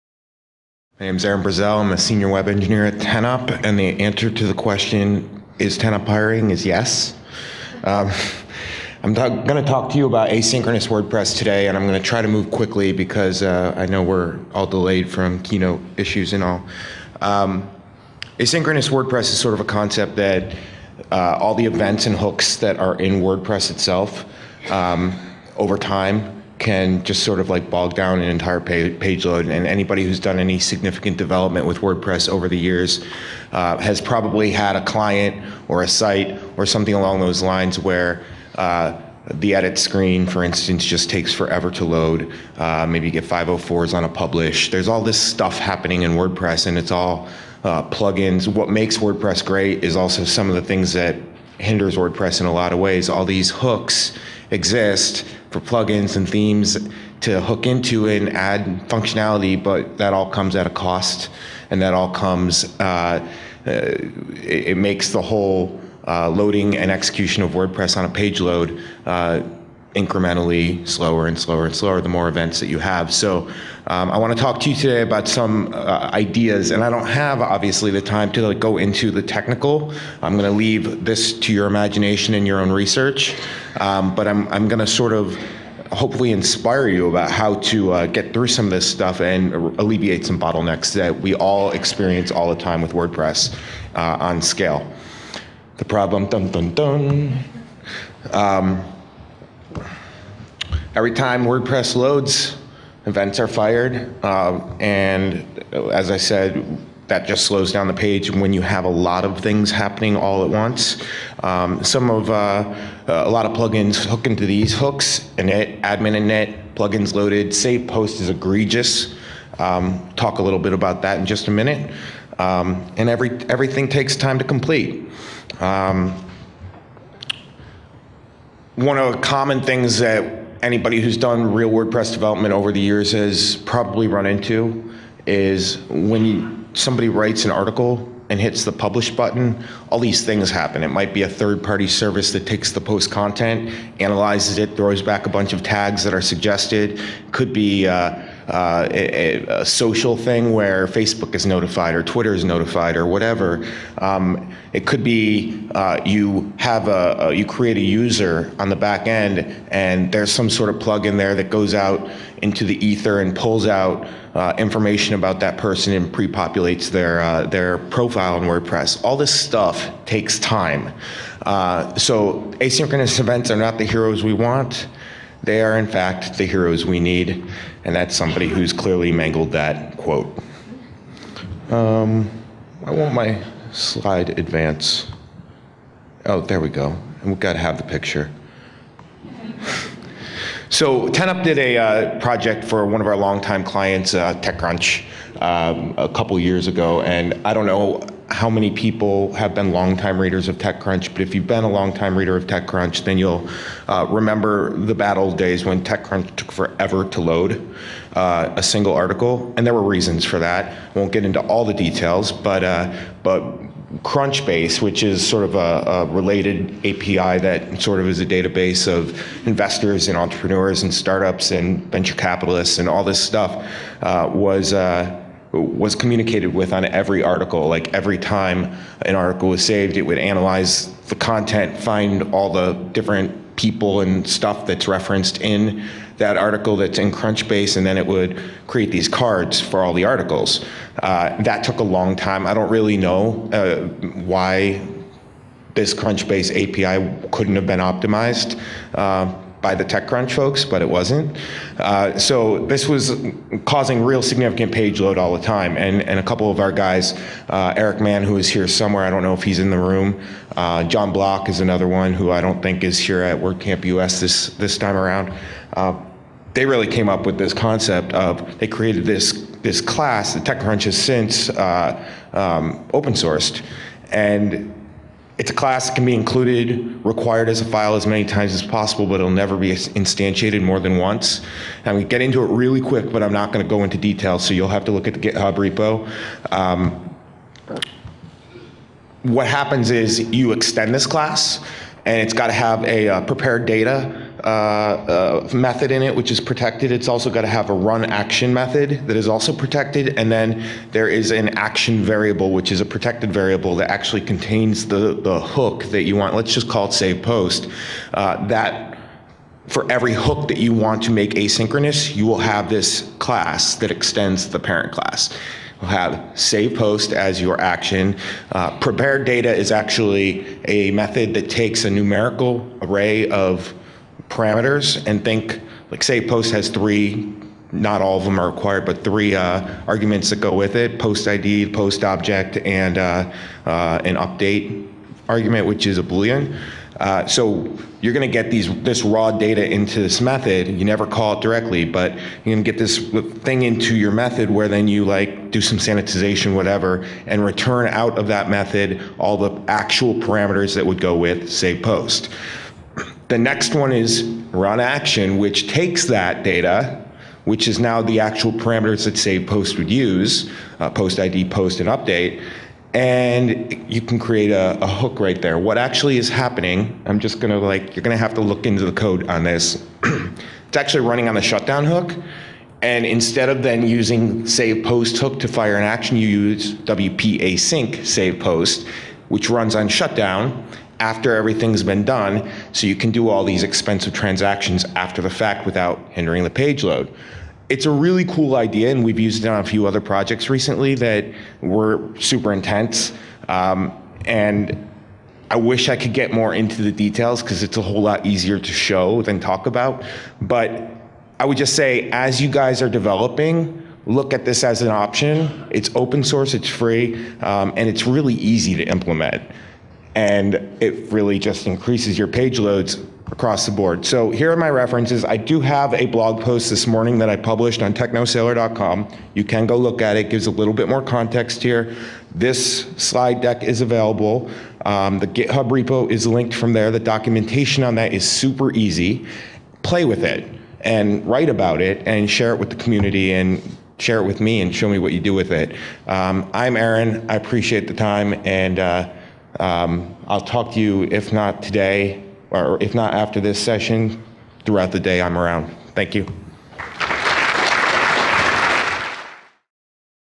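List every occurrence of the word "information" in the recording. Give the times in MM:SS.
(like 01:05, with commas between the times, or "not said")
02:44.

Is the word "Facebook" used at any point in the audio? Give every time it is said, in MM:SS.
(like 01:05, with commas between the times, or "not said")
02:30.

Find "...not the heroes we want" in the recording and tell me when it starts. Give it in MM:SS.
02:53.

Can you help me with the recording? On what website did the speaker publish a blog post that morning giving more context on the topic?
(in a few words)
technosailor.com.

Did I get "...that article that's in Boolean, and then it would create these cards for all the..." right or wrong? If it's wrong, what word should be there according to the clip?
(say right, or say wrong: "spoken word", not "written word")
wrong: "Crunchbase", not "Boolean".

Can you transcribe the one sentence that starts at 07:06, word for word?
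The documentation on that is super easy.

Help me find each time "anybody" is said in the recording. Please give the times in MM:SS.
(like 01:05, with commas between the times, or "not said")
00:29, 02:10.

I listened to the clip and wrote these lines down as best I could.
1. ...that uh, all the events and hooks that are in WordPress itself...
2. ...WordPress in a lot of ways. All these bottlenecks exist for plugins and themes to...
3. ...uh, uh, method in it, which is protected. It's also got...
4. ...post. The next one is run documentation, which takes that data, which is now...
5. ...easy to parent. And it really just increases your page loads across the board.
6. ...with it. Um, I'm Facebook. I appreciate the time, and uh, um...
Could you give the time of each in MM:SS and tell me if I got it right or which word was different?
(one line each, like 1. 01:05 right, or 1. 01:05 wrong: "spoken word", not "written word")
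1. 00:20 right
2. 00:51 wrong: "hooks", not "bottlenecks"
3. 04:54 right
4. 05:51 wrong: "action", not "documentation"
5. 06:48 wrong: "implement", not "parent"
6. 07:15 wrong: "Aaron", not "Facebook".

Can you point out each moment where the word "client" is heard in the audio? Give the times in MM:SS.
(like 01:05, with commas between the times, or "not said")
00:34, 03:13.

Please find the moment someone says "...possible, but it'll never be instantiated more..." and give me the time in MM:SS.
04:38.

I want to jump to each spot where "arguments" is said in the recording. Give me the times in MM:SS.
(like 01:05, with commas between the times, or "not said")
05:29, 05:35.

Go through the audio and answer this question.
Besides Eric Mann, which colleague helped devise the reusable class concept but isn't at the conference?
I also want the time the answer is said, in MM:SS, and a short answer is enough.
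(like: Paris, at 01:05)
John Bloch, at 04:20.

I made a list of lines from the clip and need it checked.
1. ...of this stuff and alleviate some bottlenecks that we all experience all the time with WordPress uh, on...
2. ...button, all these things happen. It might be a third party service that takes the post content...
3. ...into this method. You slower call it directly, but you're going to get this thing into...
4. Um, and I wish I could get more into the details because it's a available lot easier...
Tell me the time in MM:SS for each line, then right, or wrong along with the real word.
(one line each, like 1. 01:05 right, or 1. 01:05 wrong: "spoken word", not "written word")
1. 01:28 right
2. 02:19 right
3. 05:39 wrong: "never", not "slower"
4. 06:33 wrong: "whole", not "available".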